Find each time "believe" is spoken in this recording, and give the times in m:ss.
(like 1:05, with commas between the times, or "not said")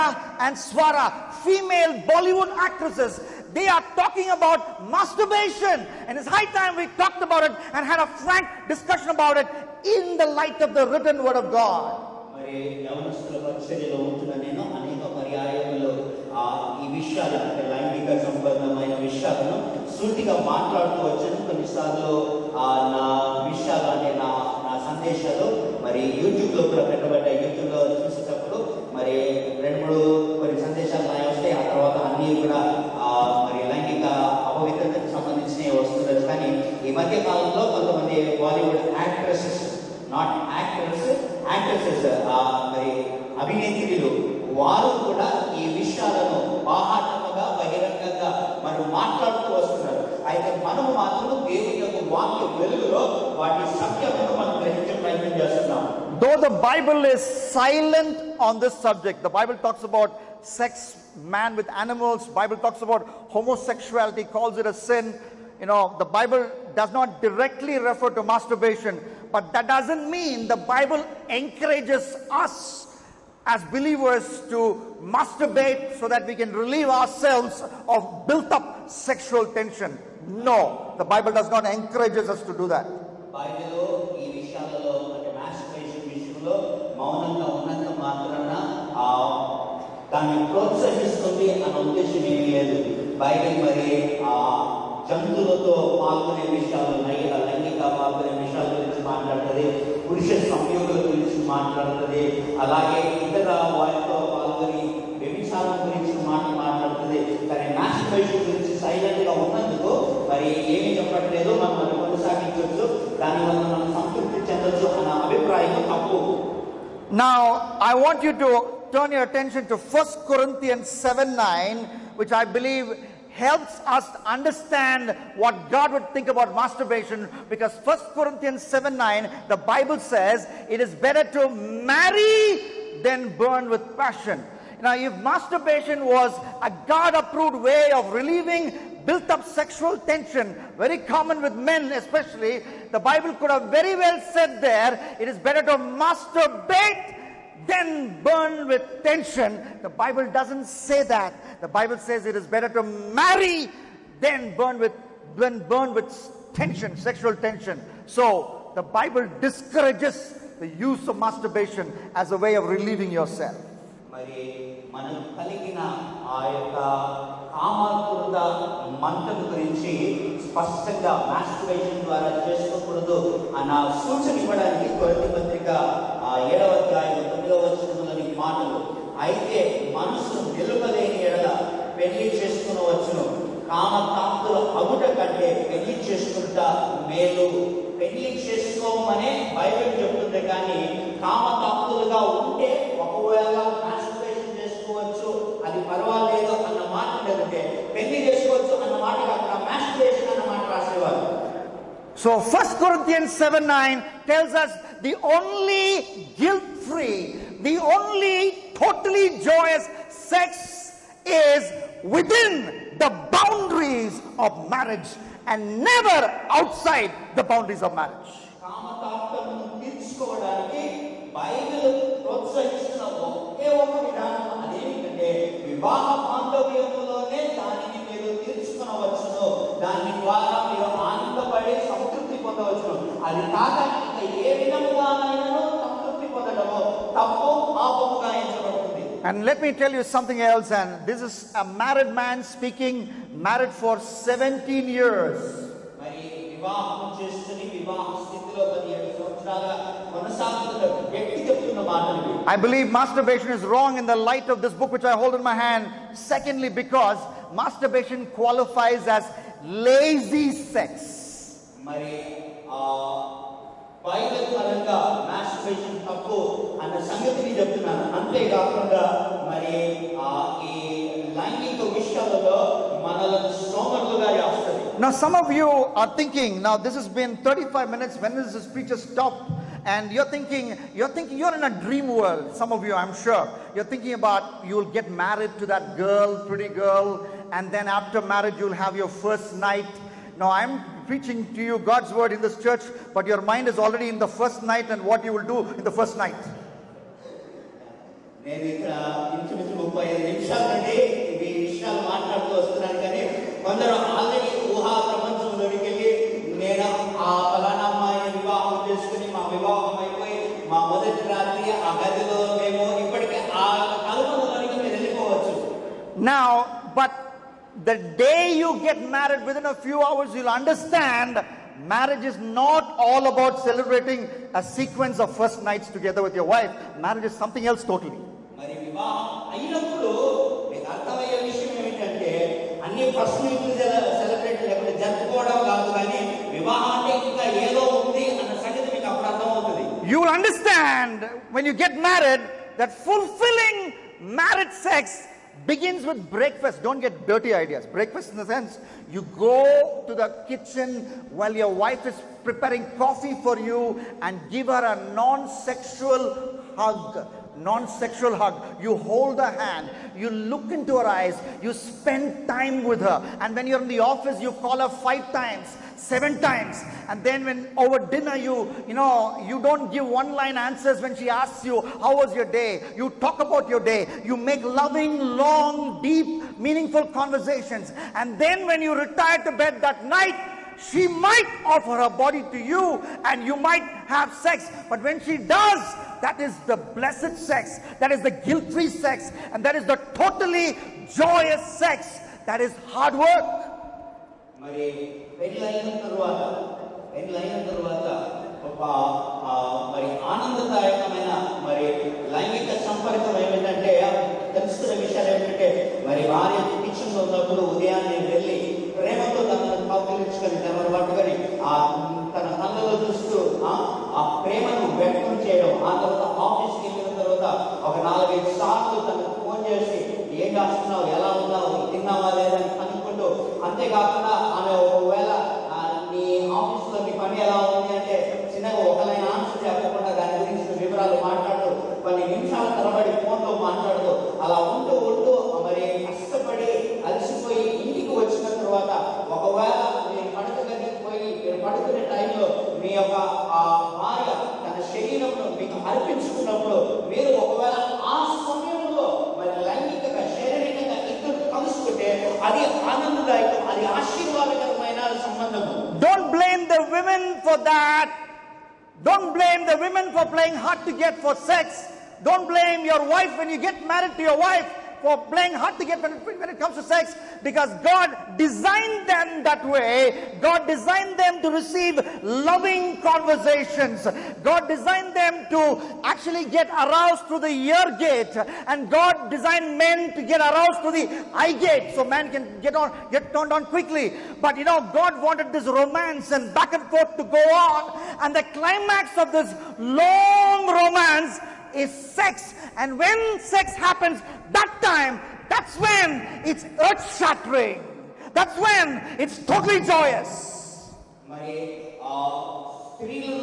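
2:02, 4:12.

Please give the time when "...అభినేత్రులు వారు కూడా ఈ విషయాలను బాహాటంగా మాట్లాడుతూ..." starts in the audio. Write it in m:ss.
0:43.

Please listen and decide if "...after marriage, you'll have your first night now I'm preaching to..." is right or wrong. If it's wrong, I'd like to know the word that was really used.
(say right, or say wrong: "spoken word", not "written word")
right.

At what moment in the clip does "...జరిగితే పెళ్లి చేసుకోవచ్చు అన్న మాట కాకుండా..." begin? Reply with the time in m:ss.
3:17.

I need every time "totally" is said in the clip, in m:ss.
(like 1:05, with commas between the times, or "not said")
3:28, 5:27, 8:19.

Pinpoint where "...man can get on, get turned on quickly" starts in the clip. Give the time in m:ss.
8:02.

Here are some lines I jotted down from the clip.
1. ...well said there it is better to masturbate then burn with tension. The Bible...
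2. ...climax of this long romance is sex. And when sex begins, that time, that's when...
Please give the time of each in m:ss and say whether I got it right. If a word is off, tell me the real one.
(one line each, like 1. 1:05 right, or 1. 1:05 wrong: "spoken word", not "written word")
1. 2:23 right
2. 8:08 wrong: "happens", not "begins".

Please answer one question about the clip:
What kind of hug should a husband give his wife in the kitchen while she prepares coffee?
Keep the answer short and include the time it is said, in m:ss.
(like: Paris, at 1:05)
Non-sexual hug, at 5:55.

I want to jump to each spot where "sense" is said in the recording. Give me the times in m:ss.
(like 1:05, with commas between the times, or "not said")
5:48.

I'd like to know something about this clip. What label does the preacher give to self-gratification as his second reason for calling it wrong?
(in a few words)
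Lazy sex.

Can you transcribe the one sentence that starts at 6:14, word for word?
You make loving, long, deep, meaningful conversations.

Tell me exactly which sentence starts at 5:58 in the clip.
You hold her hand, you look into her eyes, you spend time with her.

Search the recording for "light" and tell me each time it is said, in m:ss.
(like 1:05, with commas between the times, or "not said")
0:10, 4:14.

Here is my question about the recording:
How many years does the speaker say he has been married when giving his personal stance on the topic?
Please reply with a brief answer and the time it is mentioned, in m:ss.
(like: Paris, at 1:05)
17, at 4:03.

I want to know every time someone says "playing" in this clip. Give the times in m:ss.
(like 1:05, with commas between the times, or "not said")
7:40, 7:45.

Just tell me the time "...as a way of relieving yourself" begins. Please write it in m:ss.
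2:42.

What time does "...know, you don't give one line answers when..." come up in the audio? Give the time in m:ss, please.
6:08.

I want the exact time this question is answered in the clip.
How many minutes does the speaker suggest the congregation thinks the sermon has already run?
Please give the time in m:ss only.
4:37.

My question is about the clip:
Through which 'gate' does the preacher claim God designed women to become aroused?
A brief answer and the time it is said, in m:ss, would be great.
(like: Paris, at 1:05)
The ear gate, at 7:57.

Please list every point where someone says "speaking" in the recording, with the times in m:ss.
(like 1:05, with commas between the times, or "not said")
4:02.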